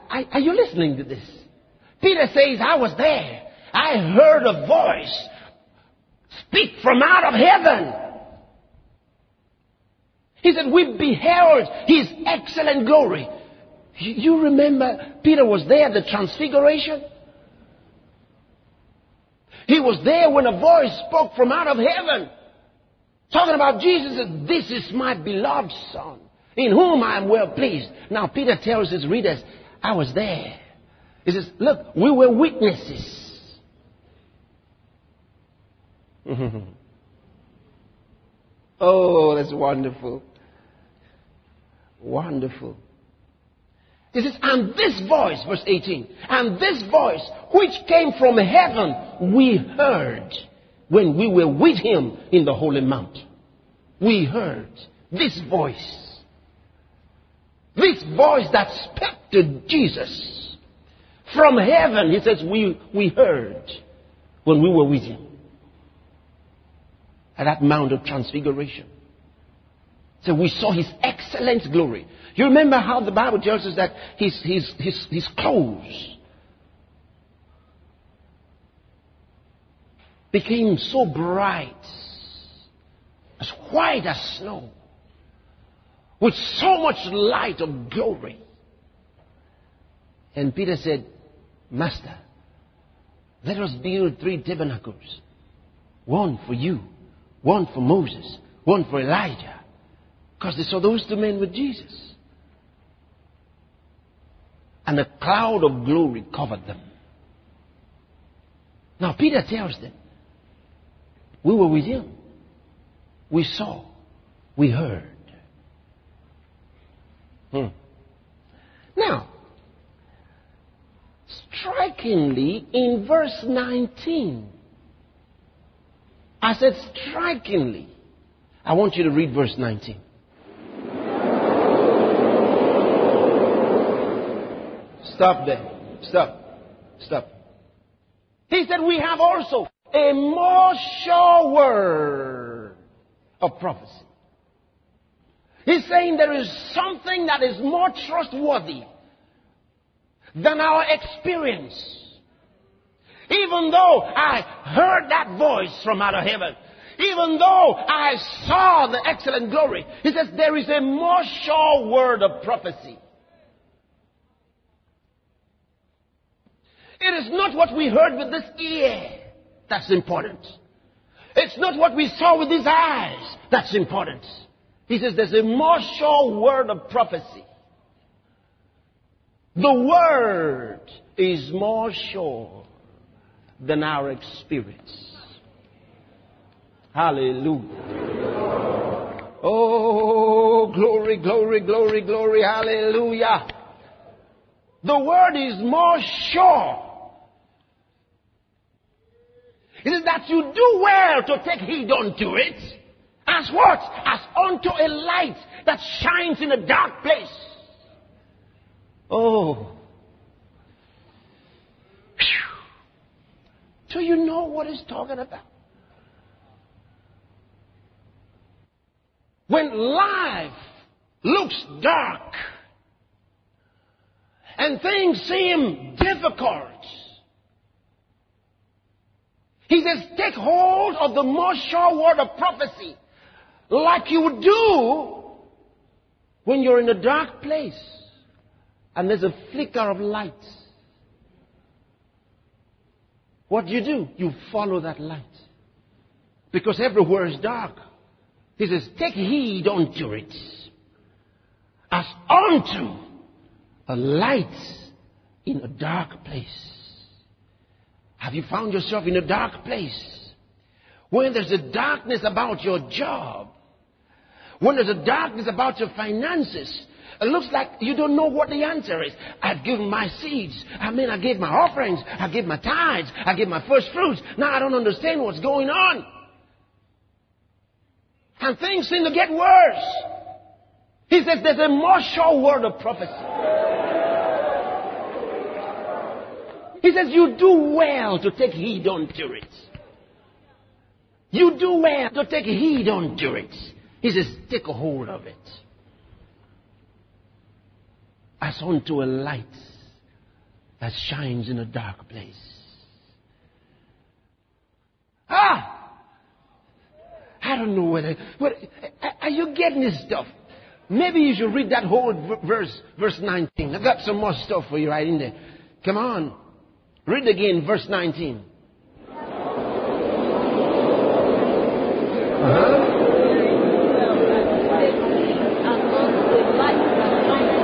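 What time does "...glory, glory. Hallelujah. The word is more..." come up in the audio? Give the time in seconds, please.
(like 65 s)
191 s.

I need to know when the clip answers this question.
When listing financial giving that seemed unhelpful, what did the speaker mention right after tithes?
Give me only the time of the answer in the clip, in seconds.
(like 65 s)
273 s.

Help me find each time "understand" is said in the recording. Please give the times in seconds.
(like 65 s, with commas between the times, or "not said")
274 s.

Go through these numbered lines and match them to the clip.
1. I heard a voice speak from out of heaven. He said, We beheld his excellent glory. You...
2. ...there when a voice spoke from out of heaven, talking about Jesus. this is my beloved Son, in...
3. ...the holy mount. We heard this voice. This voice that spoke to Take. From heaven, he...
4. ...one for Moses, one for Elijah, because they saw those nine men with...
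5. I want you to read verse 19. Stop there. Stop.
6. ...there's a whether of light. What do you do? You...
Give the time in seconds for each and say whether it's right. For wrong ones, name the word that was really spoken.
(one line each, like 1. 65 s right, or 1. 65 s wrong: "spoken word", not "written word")
1. 3 s right
2. 20 s right
3. 52 s wrong: "Jesus", not "Take"
4. 97 s wrong: "two", not "nine"
5. 128 s right
6. 239 s wrong: "flicker", not "whether".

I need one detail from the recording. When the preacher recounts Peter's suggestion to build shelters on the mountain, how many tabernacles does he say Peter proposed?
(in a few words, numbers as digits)
3.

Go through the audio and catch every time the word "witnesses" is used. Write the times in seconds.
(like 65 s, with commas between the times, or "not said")
32 s.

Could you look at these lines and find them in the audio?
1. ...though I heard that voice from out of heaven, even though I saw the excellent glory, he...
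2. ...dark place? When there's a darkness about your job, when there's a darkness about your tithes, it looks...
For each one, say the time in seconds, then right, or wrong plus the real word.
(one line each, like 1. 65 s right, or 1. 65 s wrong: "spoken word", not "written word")
1. 153 s right
2. 259 s wrong: "finances", not "tithes".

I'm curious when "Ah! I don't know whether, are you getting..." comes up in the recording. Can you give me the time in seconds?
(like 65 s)
305 s.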